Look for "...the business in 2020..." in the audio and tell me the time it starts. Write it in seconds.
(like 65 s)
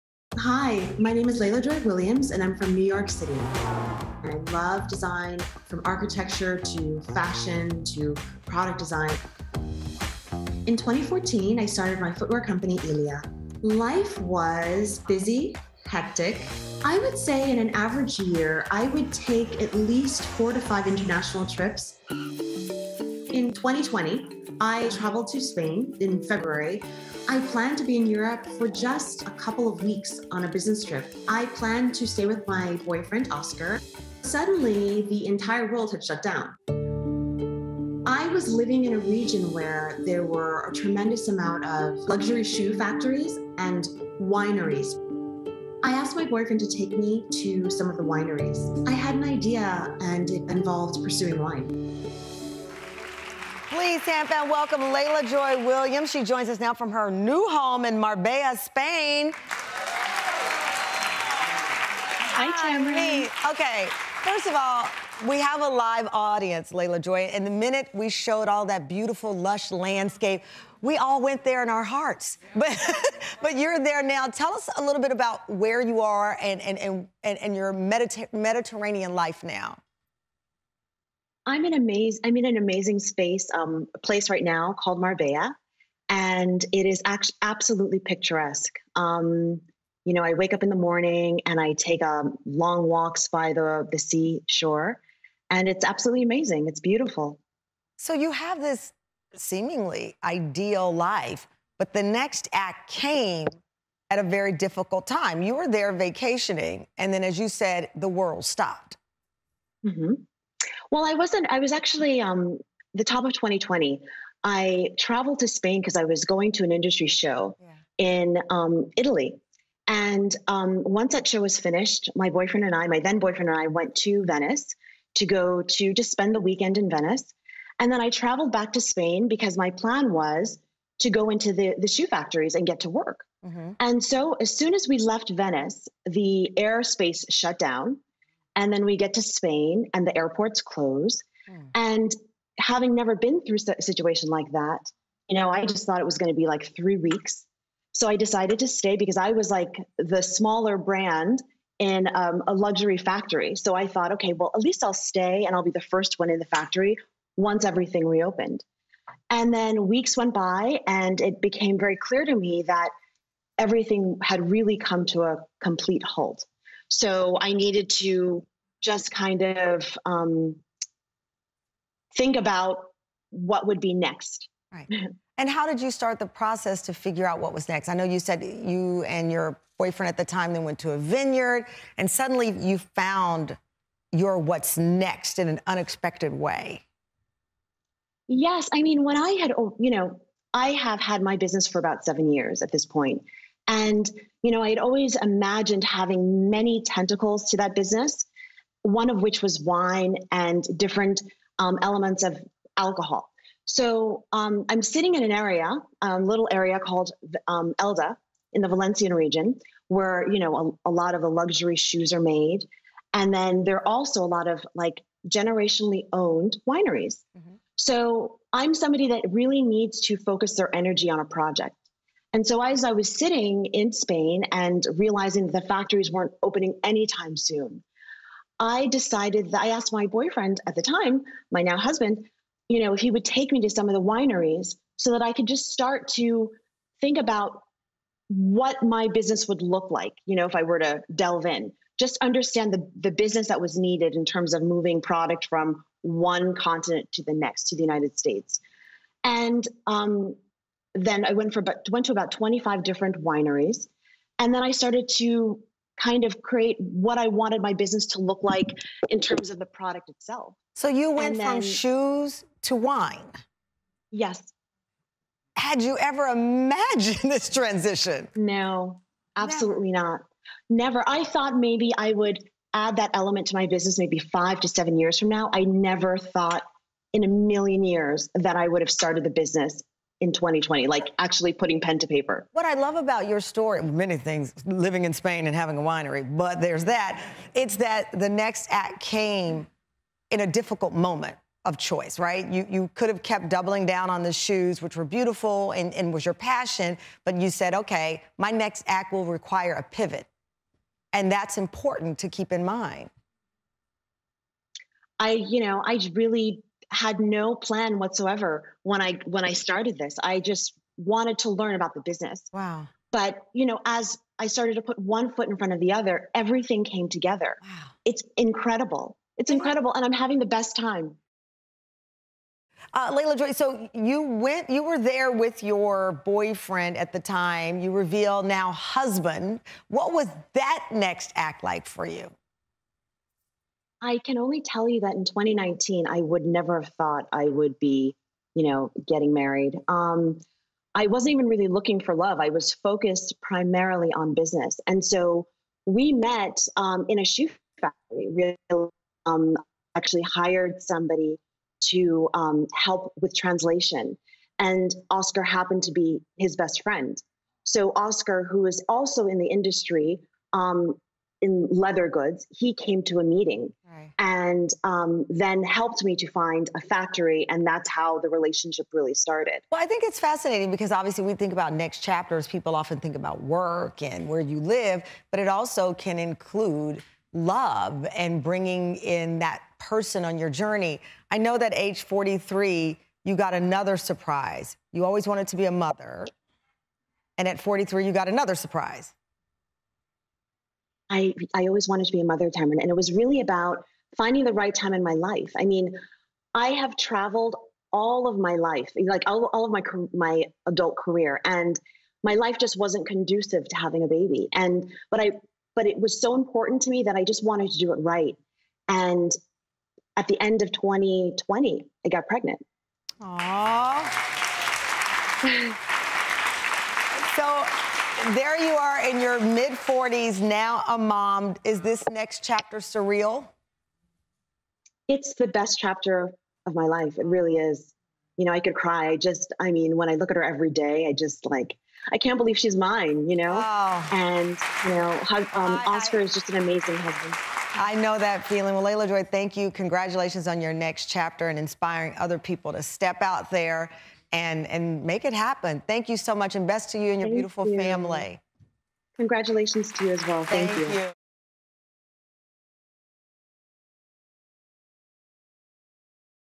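279 s.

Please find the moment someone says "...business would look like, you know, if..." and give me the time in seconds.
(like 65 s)
239 s.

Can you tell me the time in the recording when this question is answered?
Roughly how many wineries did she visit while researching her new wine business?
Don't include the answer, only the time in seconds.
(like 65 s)
252 s.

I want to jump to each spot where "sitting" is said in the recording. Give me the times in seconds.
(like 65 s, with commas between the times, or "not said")
204 s, 223 s.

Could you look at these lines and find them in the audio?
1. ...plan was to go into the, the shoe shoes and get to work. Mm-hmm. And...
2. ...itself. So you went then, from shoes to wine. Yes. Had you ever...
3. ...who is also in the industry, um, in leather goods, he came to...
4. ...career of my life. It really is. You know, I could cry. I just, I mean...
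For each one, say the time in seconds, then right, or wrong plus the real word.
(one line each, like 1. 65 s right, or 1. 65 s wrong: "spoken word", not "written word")
1. 129 s wrong: "factories", not "shoes"
2. 260 s right
3. 358 s right
4. 425 s wrong: "chapter", not "career".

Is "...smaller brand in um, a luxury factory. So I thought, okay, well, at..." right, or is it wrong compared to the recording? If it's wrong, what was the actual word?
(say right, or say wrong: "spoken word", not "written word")
right.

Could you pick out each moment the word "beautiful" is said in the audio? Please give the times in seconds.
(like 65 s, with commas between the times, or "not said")
68 s, 96 s, 295 s, 447 s.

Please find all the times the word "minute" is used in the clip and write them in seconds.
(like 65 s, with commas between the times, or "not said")
67 s.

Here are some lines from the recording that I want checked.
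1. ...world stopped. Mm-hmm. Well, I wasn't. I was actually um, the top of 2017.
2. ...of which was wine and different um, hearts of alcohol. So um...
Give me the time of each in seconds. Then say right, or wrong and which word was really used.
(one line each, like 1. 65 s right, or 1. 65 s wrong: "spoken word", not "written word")
1. 108 s wrong: "2020", not "2017"
2. 199 s wrong: "elements", not "hearts".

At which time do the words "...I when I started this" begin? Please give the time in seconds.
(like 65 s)
309 s.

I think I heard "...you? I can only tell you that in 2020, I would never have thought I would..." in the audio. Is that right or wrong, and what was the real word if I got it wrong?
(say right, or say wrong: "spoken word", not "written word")
wrong: "2019", not "2020".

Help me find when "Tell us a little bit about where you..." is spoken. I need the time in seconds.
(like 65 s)
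74 s.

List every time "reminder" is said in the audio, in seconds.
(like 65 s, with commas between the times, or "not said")
not said.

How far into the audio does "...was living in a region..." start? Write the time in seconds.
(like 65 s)
38 s.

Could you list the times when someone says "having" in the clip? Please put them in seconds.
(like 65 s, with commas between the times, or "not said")
142 s, 195 s, 285 s, 320 s, 403 s.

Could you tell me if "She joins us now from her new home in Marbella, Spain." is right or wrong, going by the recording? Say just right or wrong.
right.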